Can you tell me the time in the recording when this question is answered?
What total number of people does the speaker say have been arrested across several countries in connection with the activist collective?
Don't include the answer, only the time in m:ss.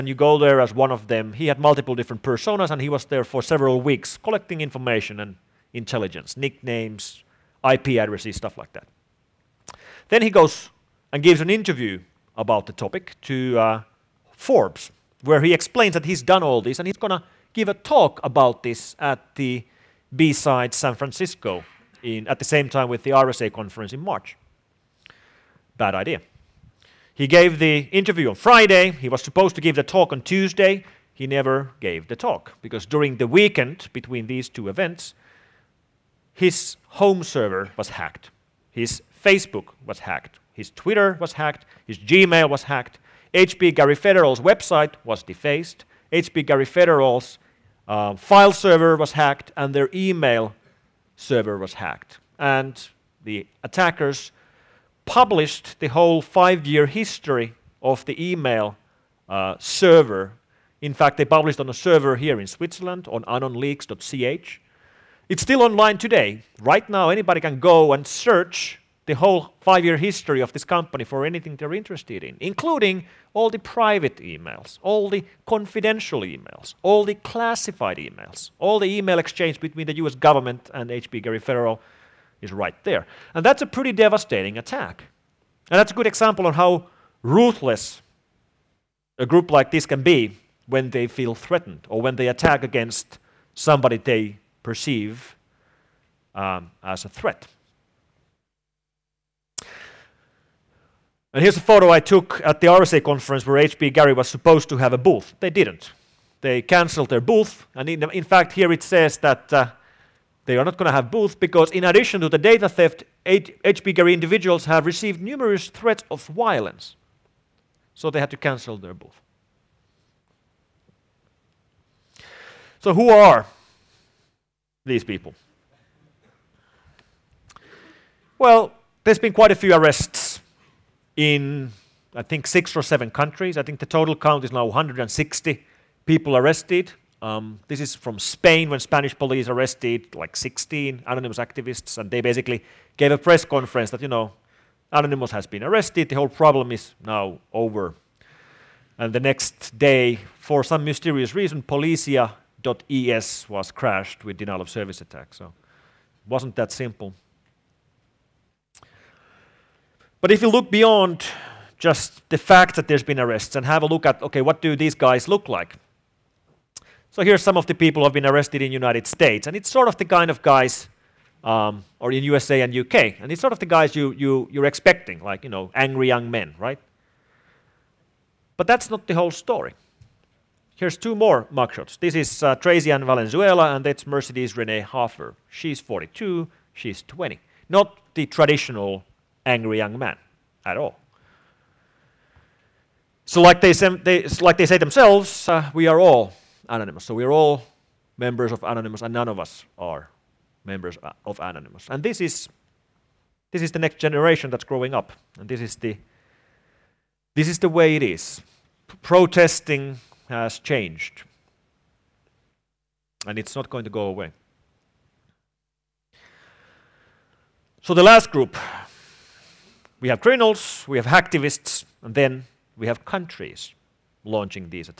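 2:14.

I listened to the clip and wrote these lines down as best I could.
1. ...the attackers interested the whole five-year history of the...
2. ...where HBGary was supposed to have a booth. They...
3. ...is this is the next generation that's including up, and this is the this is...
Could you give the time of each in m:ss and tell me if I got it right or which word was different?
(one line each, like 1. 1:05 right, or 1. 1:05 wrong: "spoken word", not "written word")
1. 0:53 wrong: "published", not "interested"
2. 1:43 right
3. 3:22 wrong: "growing", not "including".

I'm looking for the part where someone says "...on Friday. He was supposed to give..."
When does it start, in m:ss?
0:28.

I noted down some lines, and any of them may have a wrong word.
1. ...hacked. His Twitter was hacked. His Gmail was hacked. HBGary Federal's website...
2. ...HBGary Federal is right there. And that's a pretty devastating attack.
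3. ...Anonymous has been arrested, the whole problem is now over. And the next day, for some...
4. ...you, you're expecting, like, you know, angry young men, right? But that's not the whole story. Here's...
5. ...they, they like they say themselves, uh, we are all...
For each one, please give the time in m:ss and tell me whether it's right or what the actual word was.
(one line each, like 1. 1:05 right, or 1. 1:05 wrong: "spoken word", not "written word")
1. 0:39 right
2. 1:20 right
3. 2:24 right
4. 2:54 right
5. 3:13 right.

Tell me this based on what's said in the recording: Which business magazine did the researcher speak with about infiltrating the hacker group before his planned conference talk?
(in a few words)
Forbes.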